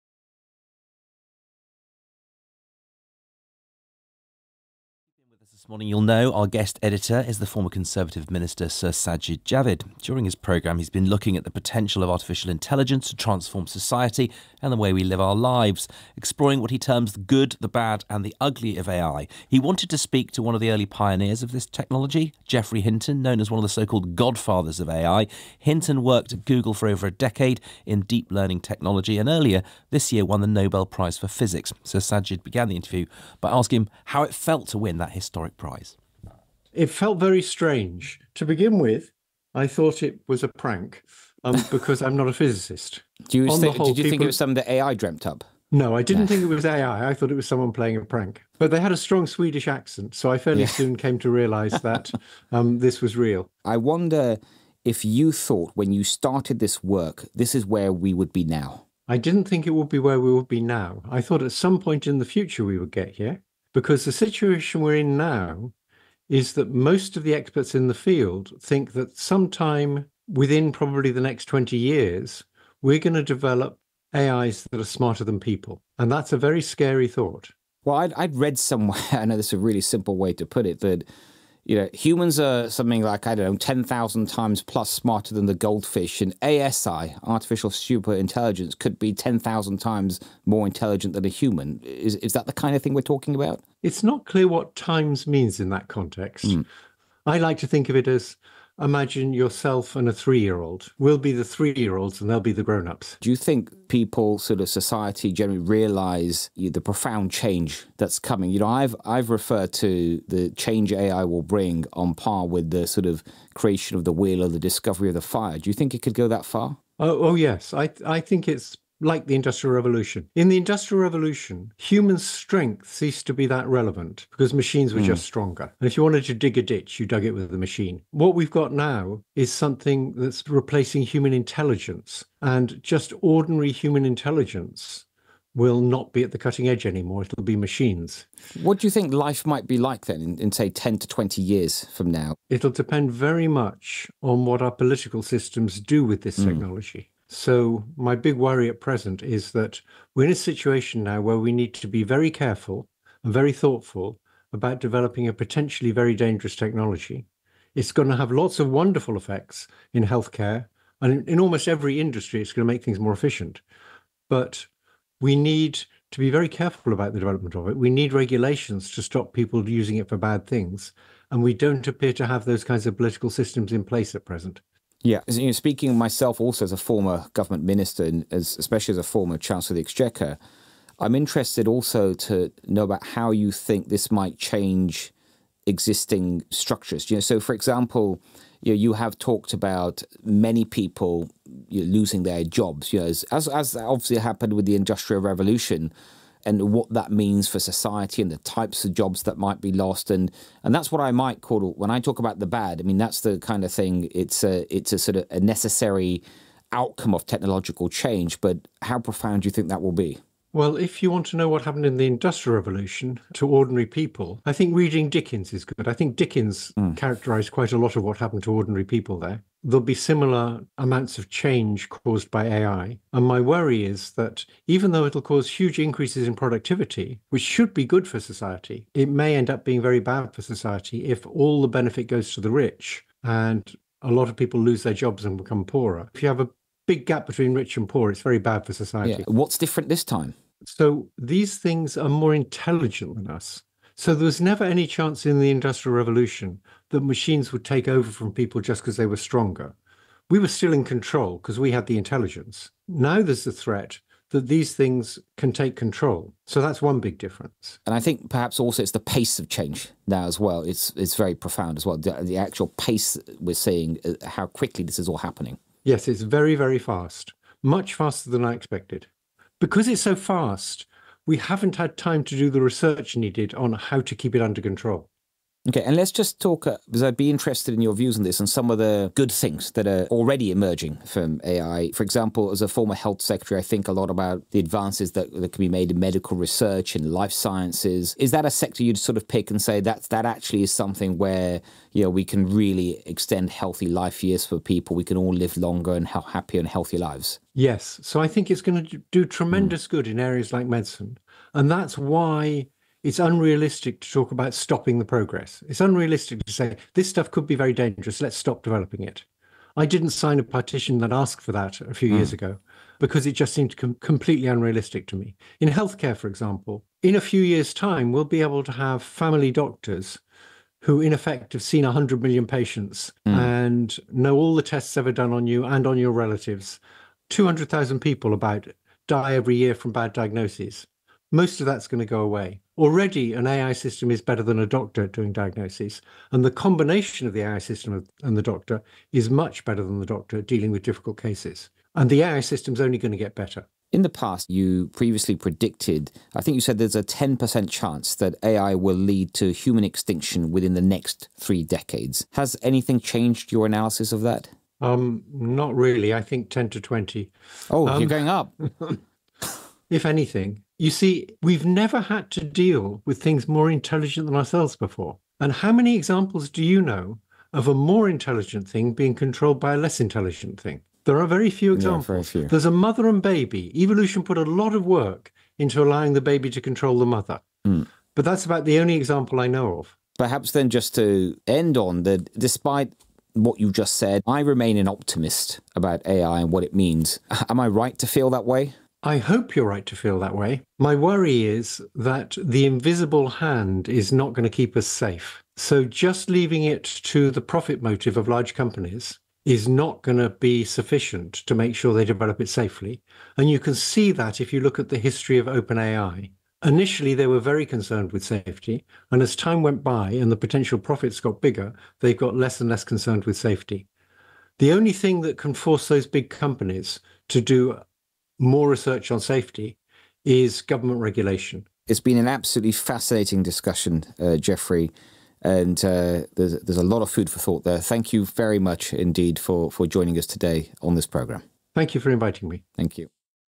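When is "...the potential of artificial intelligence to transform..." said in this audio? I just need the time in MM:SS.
00:11.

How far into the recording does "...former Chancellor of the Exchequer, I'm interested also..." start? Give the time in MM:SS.
02:59.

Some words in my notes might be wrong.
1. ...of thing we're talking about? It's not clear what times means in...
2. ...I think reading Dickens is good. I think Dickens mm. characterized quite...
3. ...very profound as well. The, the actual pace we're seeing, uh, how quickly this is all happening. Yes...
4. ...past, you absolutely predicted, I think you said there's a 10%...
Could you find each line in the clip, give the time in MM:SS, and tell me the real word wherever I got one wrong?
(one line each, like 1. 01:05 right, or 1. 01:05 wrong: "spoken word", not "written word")
1. 01:32 right
2. 03:34 right
3. 04:21 right
4. 05:44 wrong: "previously", not "absolutely".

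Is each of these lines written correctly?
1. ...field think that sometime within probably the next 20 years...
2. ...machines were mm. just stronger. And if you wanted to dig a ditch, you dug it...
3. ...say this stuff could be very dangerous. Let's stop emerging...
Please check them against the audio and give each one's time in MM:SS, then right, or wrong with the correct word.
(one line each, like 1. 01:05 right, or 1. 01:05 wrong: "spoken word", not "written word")
1. 01:07 right
2. 02:04 right
3. 05:06 wrong: "developing", not "emerging".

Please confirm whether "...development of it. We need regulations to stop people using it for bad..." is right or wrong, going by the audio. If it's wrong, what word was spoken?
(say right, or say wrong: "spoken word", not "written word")
right.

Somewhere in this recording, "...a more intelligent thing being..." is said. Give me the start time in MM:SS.
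06:07.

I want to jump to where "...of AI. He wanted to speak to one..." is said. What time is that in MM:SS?
00:18.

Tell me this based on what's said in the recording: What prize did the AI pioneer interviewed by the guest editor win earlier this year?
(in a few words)
Nobel Prize for Physics.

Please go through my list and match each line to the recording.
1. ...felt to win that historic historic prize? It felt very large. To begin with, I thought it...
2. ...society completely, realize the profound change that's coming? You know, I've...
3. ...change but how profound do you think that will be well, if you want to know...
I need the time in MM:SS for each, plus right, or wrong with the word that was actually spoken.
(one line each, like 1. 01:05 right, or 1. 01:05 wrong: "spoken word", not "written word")
1. 00:34 wrong: "strange", not "large"
2. 01:44 wrong: "generally", not "completely"
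3. 03:27 right.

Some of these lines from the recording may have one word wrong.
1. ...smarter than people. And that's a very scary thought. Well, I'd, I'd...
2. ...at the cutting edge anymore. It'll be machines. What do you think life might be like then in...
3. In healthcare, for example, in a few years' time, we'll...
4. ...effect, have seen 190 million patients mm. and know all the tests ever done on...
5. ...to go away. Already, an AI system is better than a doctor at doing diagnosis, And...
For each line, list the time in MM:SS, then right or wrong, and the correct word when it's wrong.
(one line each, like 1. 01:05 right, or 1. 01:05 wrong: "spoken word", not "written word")
1. 01:14 right
2. 02:16 right
3. 05:15 right
4. 05:21 wrong: "100", not "190"
5. 05:31 right.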